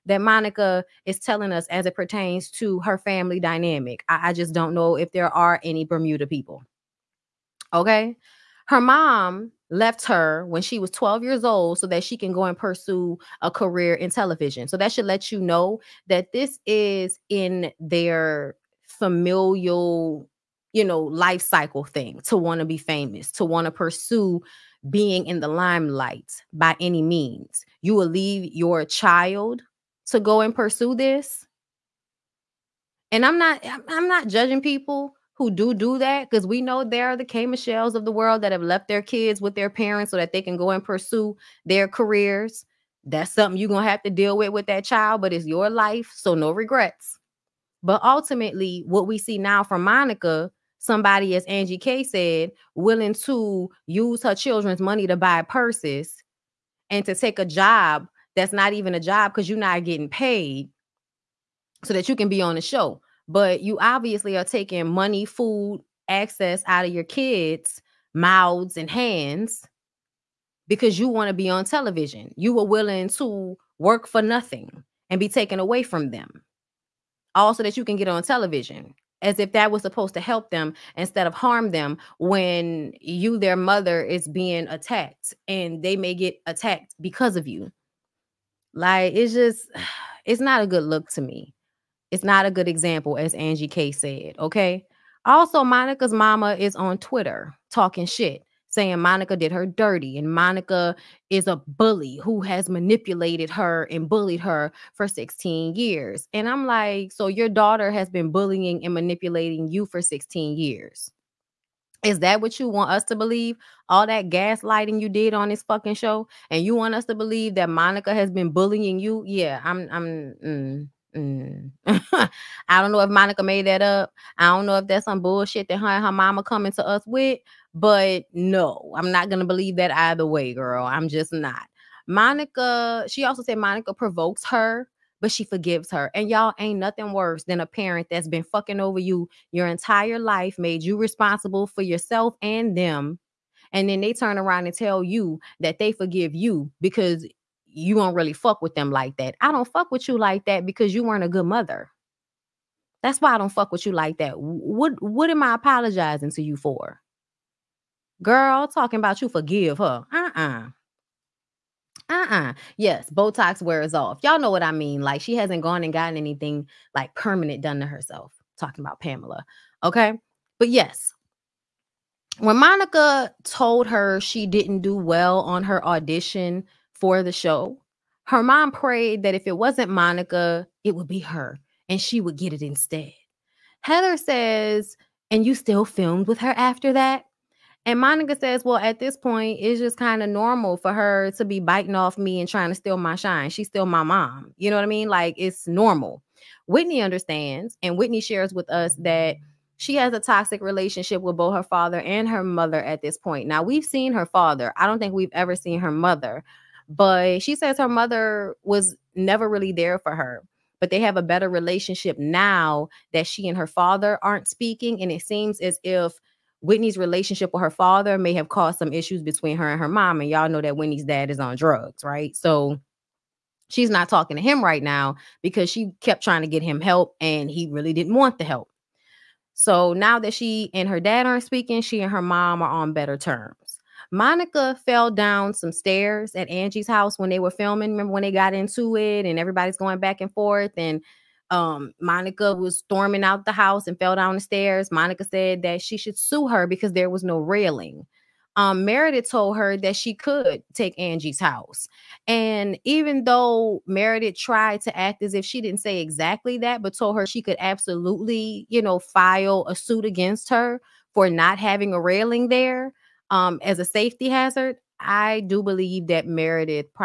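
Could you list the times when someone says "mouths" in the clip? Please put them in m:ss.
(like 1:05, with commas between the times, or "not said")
1:08.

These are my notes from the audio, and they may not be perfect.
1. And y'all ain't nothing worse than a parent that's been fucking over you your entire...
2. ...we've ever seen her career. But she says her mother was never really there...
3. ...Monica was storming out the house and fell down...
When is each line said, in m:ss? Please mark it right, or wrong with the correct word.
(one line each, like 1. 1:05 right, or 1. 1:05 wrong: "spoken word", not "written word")
1. 2:16 right
2. 3:25 wrong: "mother", not "career"
3. 4:01 right.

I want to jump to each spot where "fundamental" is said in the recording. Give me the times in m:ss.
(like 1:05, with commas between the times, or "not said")
not said.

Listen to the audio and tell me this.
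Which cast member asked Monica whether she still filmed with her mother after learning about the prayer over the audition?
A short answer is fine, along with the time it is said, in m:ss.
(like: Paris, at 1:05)
Heather, at 3:03.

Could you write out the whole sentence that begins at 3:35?
And it seems as if Whitney's relationship with her father may have caused some issues between her and her mom.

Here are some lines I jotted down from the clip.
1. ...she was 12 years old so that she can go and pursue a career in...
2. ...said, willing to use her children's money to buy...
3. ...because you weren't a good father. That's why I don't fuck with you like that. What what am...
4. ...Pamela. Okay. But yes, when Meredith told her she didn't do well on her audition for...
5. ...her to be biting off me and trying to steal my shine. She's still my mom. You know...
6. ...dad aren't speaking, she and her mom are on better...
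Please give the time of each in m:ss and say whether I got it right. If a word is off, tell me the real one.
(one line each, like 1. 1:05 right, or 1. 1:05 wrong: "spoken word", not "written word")
1. 0:10 right
2. 0:52 right
3. 2:30 wrong: "mother", not "father"
4. 2:48 wrong: "Monica", not "Meredith"
5. 3:10 right
6. 3:50 right.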